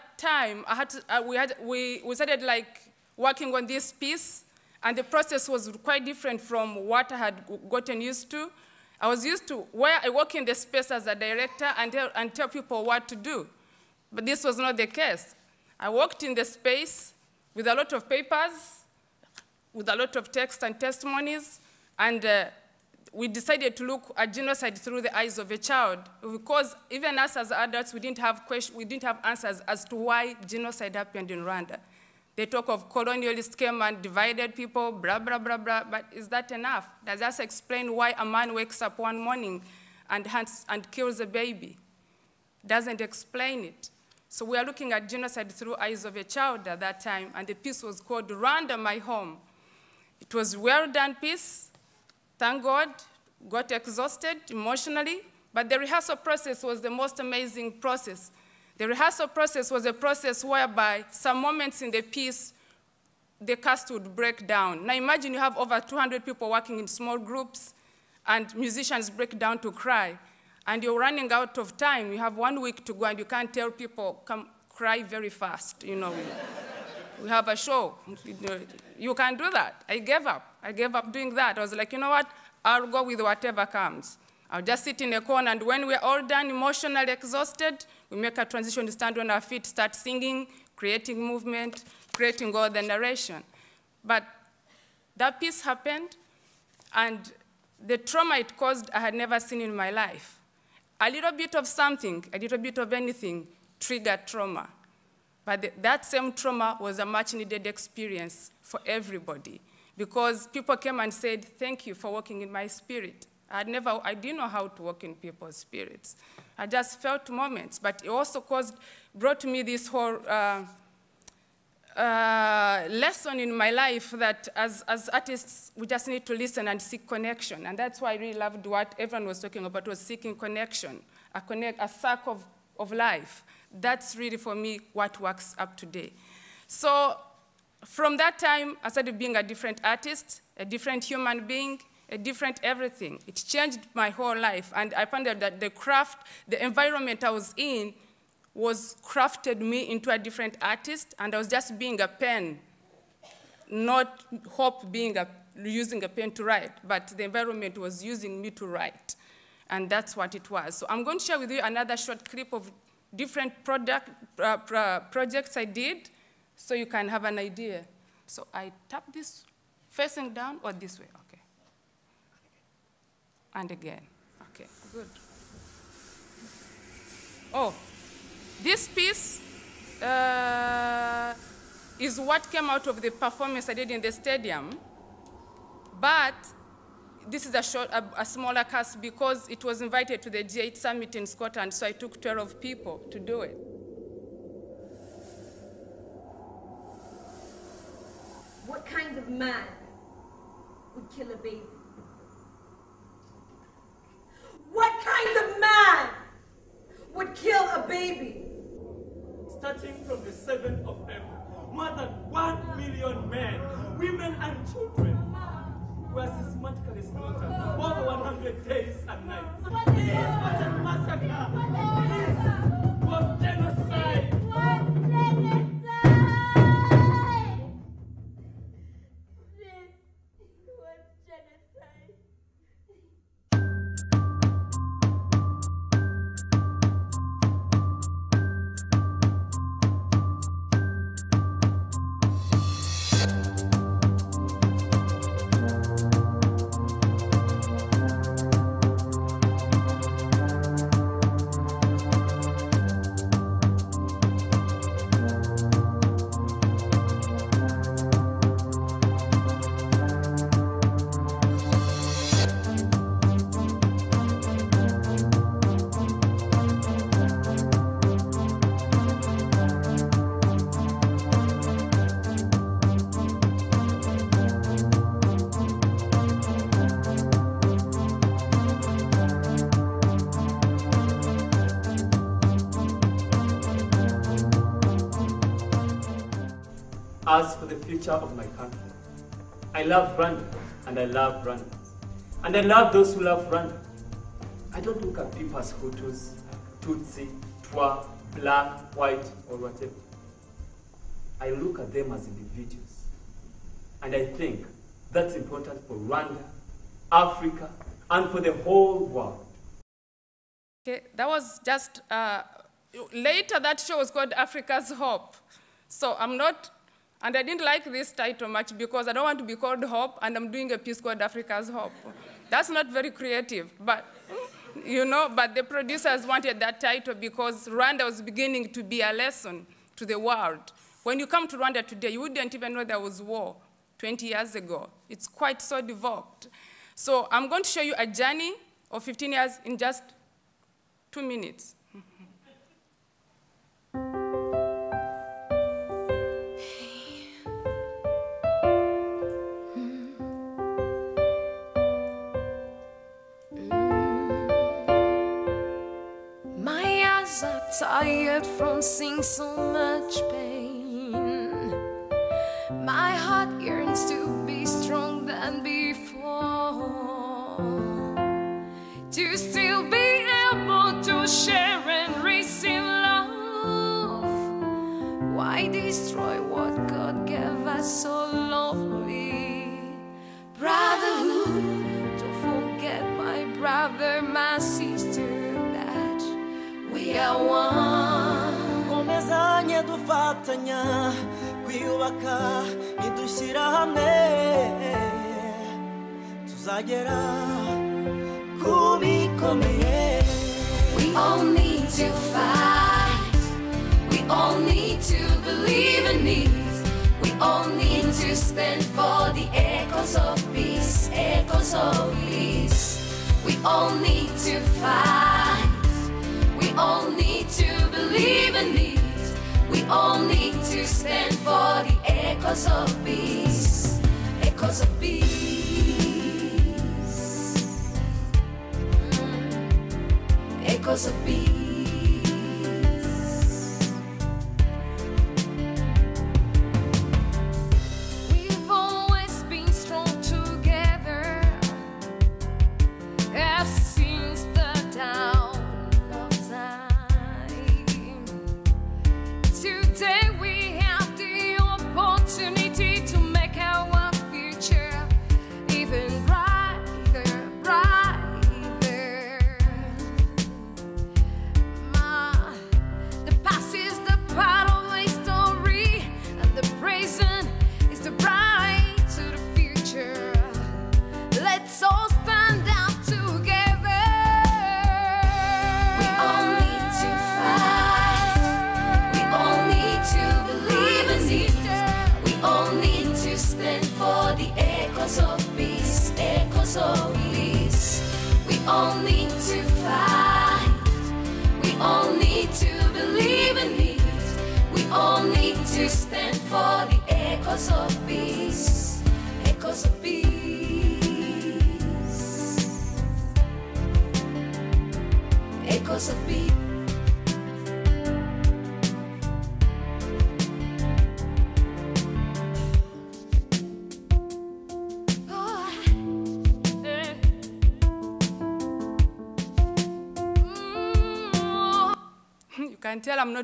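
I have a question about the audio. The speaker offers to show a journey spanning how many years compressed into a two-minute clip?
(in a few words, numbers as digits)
15.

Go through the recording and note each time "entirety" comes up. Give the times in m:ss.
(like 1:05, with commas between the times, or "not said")
not said.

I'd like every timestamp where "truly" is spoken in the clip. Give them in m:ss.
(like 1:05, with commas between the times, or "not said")
not said.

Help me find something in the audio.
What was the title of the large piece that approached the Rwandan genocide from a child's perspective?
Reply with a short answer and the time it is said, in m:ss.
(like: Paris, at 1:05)
Rwanda, My Home, at 0:48.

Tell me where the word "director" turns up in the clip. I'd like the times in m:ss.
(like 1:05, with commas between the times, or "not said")
0:11.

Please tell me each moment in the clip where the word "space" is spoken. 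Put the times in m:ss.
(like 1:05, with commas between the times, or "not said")
0:10, 0:16.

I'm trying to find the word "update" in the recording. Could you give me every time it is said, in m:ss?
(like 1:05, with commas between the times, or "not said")
not said.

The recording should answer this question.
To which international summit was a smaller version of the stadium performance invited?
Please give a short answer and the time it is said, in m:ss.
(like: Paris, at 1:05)
G8 summit, at 3:10.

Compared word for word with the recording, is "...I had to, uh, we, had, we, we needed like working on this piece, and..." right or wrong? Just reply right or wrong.
wrong.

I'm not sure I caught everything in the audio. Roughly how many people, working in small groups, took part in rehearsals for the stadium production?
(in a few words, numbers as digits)
200.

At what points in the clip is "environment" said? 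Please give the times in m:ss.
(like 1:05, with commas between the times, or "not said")
2:26, 2:37.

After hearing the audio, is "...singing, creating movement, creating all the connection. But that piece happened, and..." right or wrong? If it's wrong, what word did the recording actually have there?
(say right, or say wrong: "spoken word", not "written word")
wrong: "narration", not "connection".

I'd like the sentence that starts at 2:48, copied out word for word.
So I tap this facing down or this way, okay.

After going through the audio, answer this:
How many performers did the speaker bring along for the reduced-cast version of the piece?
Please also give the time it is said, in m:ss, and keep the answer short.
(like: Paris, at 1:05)
12, at 3:12.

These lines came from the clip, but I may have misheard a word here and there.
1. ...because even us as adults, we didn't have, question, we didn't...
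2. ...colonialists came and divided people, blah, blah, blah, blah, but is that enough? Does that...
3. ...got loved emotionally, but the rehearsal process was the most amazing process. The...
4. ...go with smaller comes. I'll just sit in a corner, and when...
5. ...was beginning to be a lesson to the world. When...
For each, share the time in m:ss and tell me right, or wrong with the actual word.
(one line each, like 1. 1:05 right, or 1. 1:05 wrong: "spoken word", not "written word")
1. 0:26 right
2. 0:32 right
3. 0:53 wrong: "exhausted", not "loved"
4. 1:22 wrong: "whatever", not "smaller"
5. 5:28 right.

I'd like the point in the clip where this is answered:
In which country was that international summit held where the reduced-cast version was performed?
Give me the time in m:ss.
3:11.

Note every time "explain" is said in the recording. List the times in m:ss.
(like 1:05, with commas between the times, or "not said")
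0:37, 0:43.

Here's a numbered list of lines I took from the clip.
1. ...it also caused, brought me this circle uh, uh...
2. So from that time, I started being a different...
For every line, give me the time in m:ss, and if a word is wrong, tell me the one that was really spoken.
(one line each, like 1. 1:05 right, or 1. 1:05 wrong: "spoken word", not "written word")
1. 1:58 wrong: "whole", not "circle"
2. 2:16 right.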